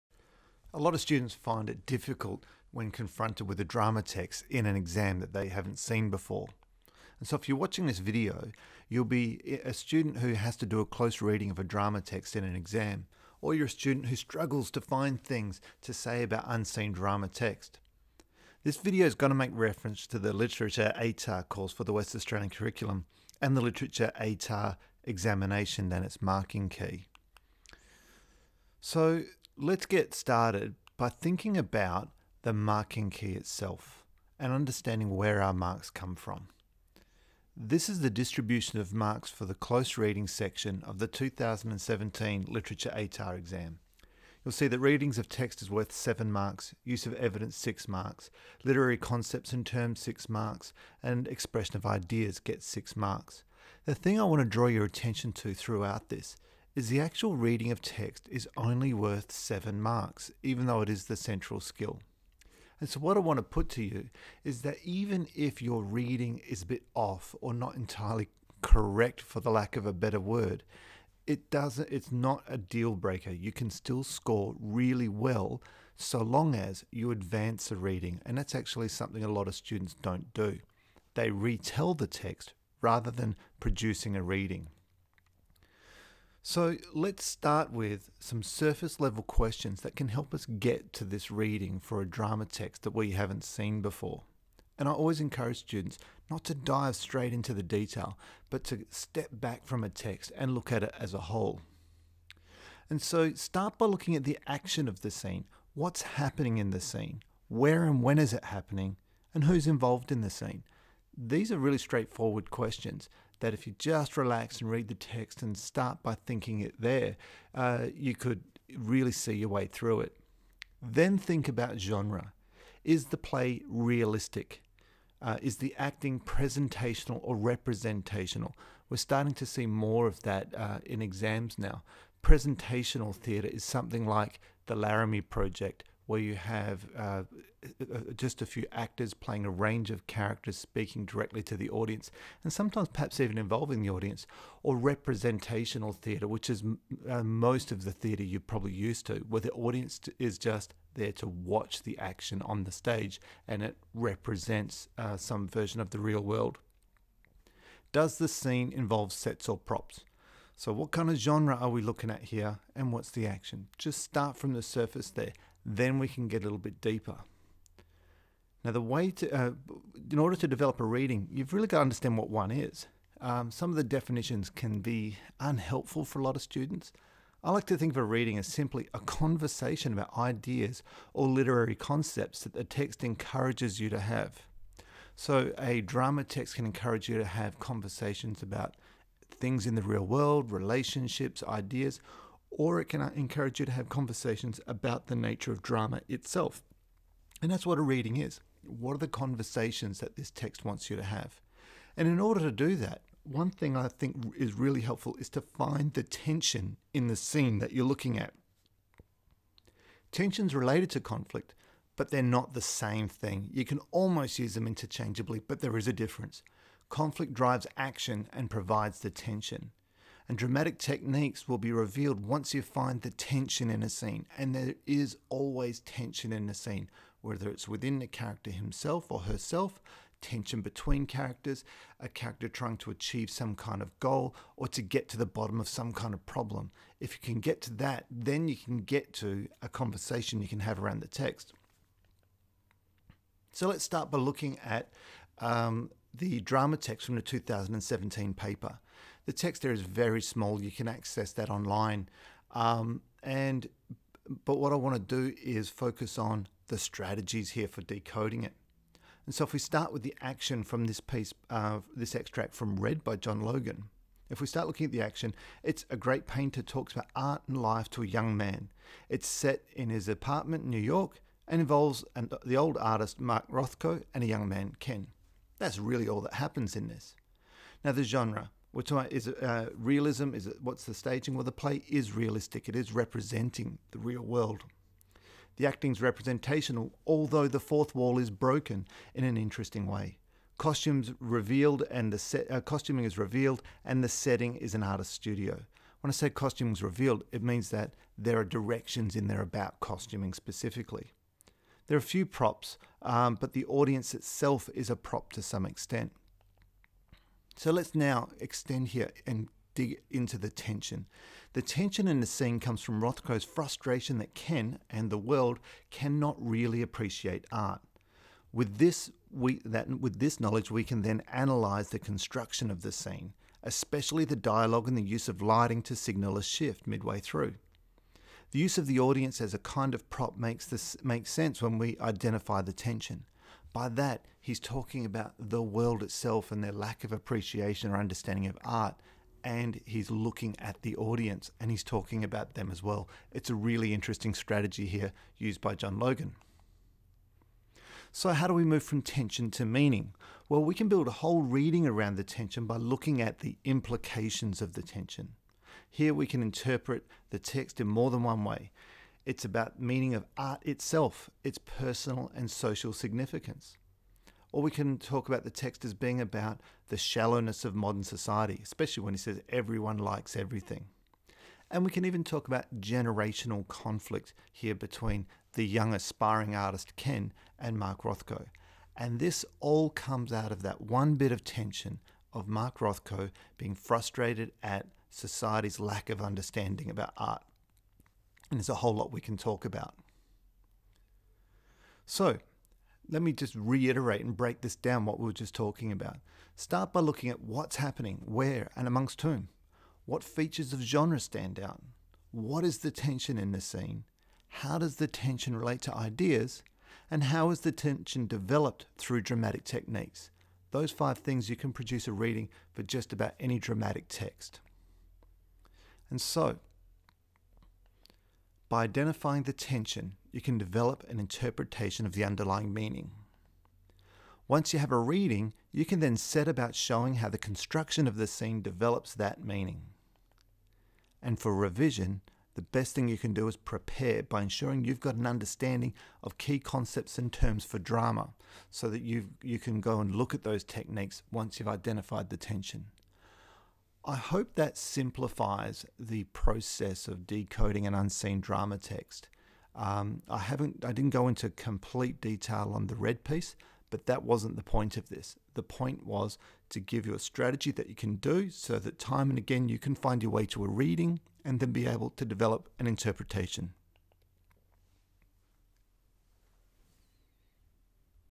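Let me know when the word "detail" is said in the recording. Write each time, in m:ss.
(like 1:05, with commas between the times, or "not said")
1:37, 7:32.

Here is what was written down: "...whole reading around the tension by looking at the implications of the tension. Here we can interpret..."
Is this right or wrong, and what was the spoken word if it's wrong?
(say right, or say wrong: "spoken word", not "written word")
right.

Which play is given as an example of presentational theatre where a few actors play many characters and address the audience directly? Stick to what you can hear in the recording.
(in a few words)
The Laramie Project.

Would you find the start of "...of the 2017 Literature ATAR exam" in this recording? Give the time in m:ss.
0:40.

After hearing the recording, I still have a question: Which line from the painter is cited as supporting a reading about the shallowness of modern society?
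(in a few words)
everyone likes everything.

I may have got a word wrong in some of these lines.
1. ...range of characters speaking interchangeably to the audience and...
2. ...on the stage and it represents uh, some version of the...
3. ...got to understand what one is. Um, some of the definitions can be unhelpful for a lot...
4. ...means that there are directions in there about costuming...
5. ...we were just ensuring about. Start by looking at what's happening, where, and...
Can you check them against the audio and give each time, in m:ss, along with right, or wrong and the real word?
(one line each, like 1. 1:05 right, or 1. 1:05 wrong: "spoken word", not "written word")
1. 2:19 wrong: "directly", not "interchangeably"
2. 2:32 right
3. 2:51 right
4. 4:57 right
5. 6:35 wrong: "talking", not "ensuring".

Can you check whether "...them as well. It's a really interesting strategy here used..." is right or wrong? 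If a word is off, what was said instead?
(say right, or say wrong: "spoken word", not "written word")
right.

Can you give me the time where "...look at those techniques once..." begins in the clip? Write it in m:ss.
7:20.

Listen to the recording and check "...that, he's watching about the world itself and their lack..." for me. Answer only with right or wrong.
wrong.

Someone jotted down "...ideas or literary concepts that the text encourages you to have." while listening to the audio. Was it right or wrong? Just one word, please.
right.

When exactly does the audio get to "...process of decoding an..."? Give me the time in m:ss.
7:26.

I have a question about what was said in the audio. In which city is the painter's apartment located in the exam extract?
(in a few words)
New York.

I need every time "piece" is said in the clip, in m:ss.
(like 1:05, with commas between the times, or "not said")
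4:20, 7:33.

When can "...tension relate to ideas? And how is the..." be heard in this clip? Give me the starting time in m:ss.
6:45.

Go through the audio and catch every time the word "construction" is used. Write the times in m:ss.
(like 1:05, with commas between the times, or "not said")
5:21, 7:07.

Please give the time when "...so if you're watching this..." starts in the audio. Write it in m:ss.
0:07.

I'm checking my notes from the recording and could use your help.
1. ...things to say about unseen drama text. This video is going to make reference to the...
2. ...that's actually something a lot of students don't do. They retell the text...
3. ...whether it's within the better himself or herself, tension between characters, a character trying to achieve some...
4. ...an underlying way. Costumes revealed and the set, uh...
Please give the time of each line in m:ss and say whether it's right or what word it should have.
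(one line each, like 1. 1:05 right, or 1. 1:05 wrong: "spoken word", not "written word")
1. 0:15 right
2. 1:18 right
3. 3:47 wrong: "character", not "better"
4. 4:49 wrong: "interesting", not "underlying".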